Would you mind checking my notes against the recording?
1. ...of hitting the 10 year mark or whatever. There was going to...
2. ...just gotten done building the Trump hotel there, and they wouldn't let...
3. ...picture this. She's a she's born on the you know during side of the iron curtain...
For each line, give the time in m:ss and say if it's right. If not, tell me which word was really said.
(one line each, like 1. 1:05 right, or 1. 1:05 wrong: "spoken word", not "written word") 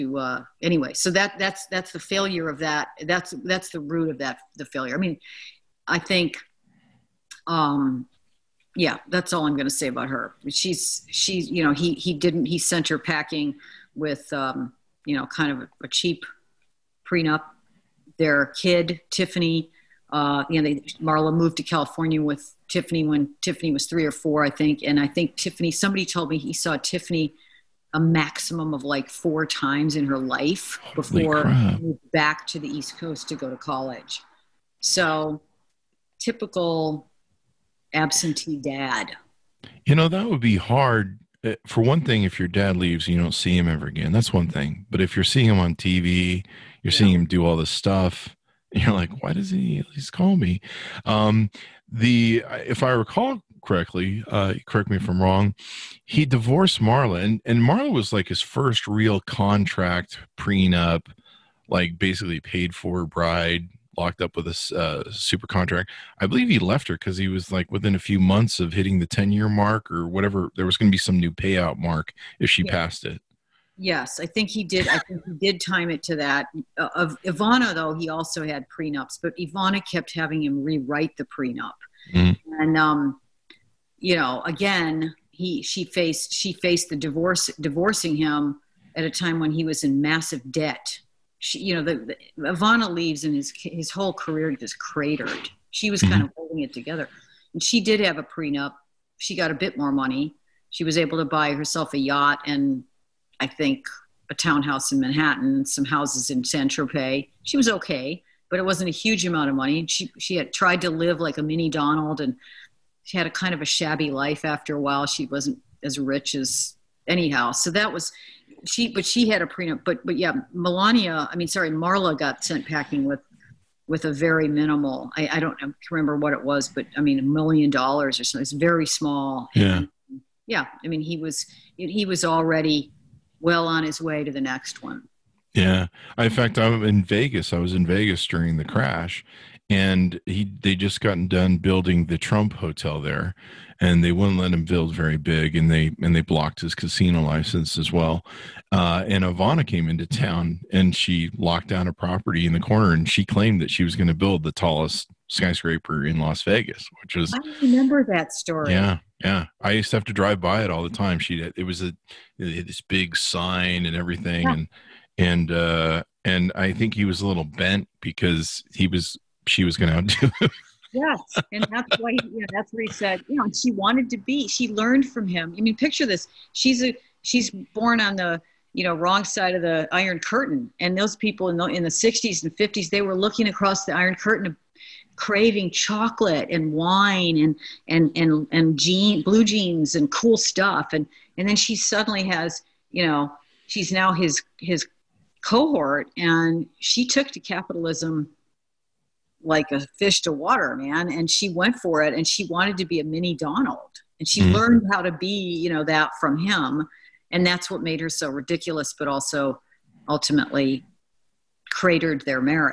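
1. 1:08 right
2. 2:20 right
3. 2:55 wrong: "wrong", not "during".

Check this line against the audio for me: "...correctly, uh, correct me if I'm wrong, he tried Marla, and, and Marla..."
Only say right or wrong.
wrong.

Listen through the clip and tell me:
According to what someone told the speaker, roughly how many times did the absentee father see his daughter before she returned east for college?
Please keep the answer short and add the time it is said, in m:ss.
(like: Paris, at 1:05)
4, at 0:29.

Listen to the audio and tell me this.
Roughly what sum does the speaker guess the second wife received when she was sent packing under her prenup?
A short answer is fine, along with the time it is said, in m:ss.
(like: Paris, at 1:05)
$1 million, at 2:07.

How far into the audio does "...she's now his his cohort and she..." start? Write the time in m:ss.
3:13.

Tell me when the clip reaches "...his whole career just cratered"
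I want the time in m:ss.
1:33.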